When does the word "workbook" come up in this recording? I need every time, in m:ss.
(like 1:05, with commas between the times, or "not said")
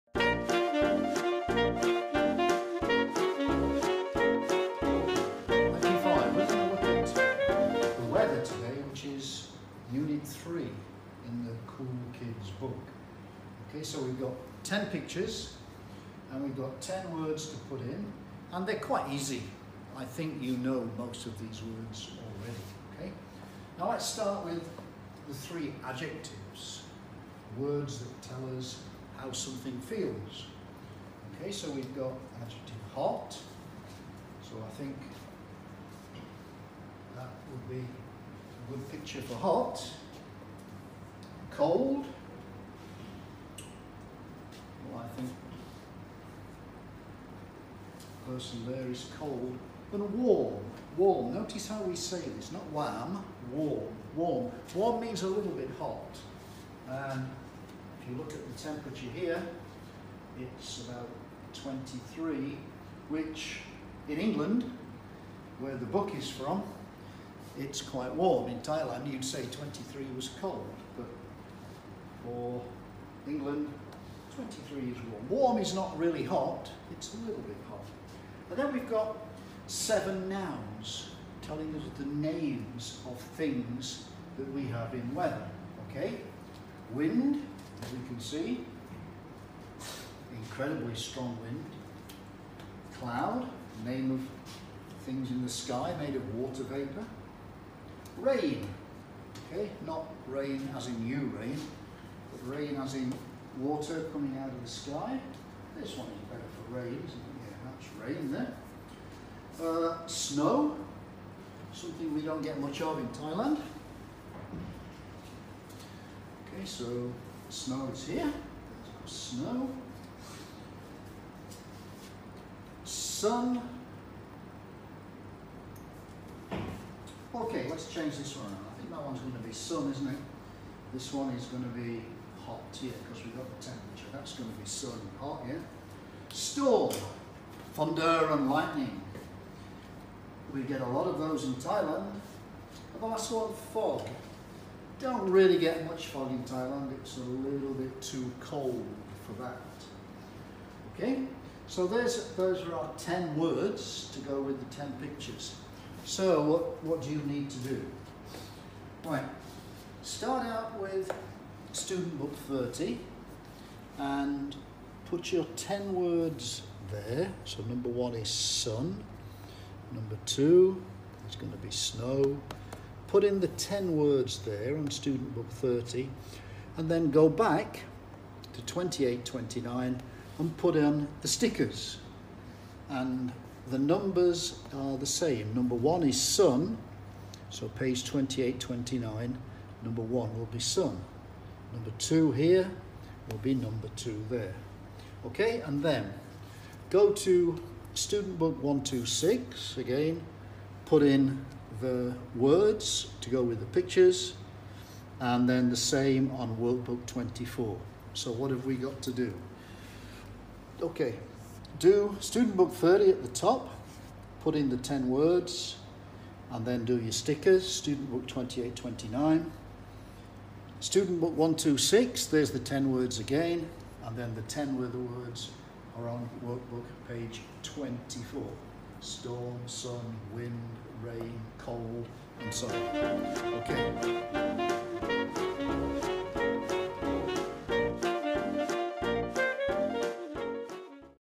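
3:26, 3:46.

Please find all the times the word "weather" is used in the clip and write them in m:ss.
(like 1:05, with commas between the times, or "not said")
1:25.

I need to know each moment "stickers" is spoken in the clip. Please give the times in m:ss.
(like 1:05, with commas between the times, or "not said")
3:01, 3:37.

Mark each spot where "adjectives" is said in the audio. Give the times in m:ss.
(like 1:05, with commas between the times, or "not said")
0:25, 0:32.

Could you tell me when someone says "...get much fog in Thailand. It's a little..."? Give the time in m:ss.
2:25.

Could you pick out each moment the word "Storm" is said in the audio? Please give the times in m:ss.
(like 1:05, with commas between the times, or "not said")
2:16, 3:48.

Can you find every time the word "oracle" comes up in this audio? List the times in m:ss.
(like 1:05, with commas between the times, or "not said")
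not said.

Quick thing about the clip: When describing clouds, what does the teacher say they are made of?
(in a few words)
water vapour.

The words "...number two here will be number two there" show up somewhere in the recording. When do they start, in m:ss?
3:11.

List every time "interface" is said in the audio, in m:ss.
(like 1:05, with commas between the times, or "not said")
not said.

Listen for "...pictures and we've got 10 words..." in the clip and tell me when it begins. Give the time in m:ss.
0:14.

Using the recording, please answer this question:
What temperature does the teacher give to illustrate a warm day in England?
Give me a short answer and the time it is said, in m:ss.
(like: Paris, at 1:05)
23, at 1:00.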